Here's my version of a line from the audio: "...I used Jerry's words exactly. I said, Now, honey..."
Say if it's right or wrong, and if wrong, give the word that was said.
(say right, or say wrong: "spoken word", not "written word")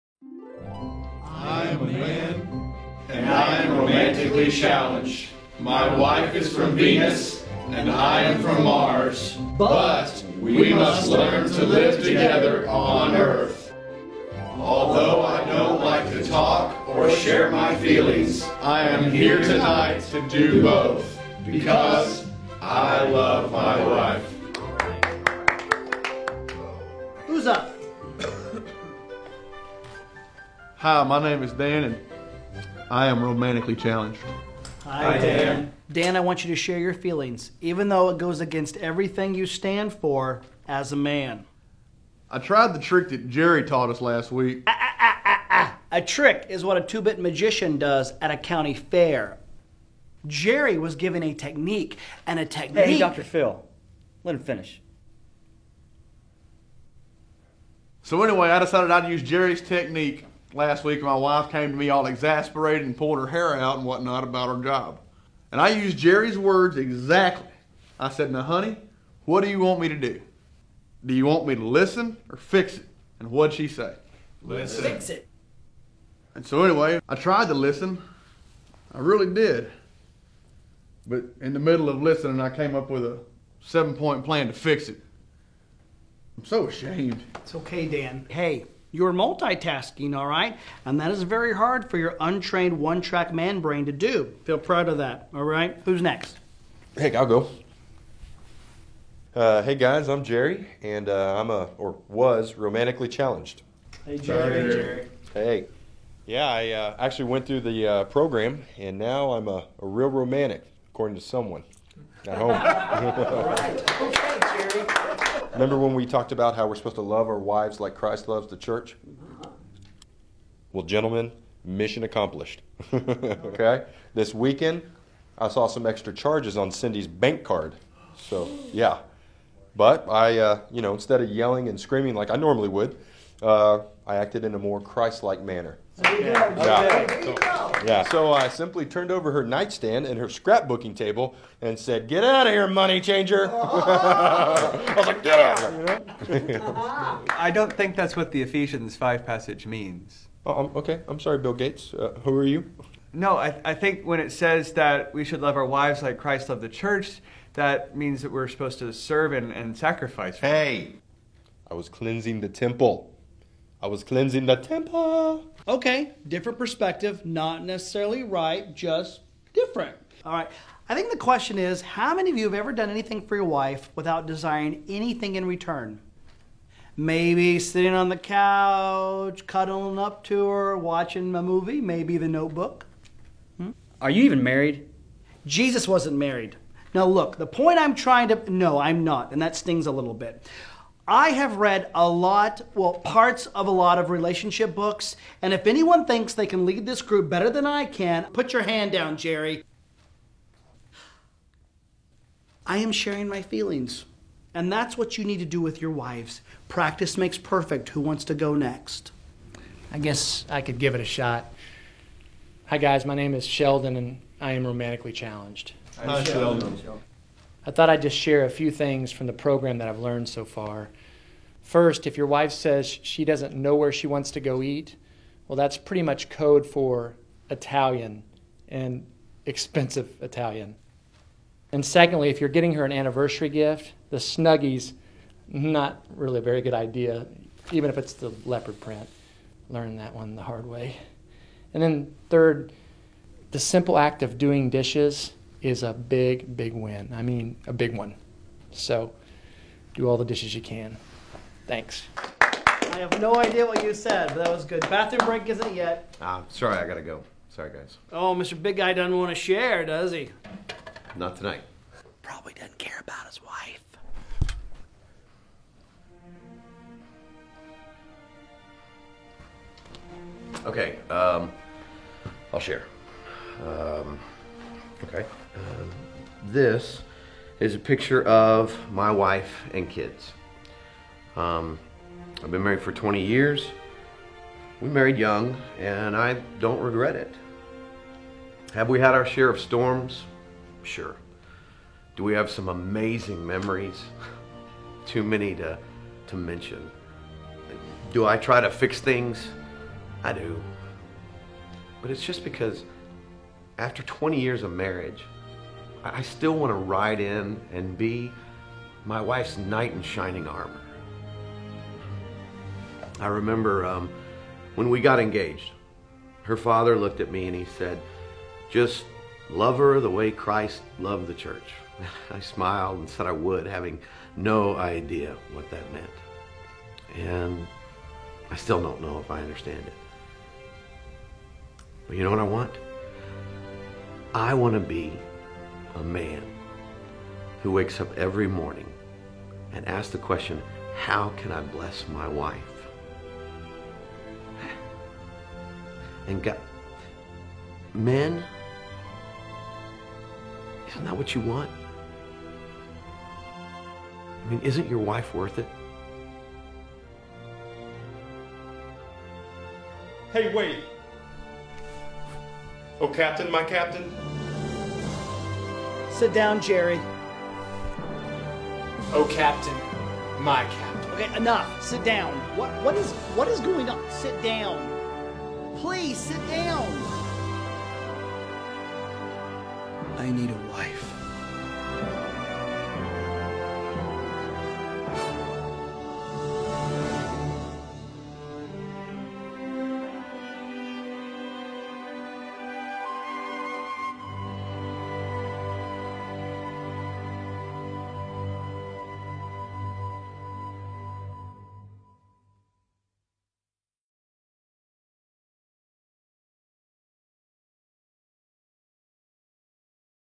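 right.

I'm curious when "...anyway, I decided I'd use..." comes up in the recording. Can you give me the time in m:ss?
0:58.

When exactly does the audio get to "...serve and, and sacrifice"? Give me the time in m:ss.
2:38.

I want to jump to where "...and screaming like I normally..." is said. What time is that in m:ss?
2:11.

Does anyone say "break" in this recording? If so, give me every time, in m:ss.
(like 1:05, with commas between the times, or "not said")
4:15.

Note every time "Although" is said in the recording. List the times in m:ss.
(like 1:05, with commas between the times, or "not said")
0:14.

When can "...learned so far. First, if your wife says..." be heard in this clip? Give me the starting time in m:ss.
3:39.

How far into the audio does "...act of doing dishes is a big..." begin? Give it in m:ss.
4:03.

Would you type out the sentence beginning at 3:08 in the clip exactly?
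No, I'm not, and that stings a little bit.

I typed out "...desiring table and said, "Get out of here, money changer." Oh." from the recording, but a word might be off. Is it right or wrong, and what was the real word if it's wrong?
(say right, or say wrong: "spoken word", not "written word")
wrong: "scrapbooking", not "desiring".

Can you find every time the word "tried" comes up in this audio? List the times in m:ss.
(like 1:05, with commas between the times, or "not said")
0:42, 1:17.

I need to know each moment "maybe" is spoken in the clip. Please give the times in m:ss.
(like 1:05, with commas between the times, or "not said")
2:56, 3:01.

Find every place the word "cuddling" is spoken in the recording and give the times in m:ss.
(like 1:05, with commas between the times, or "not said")
2:59.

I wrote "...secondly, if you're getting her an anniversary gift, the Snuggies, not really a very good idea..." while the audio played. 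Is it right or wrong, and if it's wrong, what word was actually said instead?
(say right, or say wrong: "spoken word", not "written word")
right.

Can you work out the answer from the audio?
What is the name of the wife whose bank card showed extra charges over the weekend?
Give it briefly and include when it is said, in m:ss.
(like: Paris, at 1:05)
Cindy, at 2:06.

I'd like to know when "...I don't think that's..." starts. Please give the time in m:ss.
2:27.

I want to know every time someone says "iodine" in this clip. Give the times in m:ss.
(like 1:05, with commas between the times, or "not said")
not said.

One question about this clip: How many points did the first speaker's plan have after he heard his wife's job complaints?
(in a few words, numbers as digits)
7.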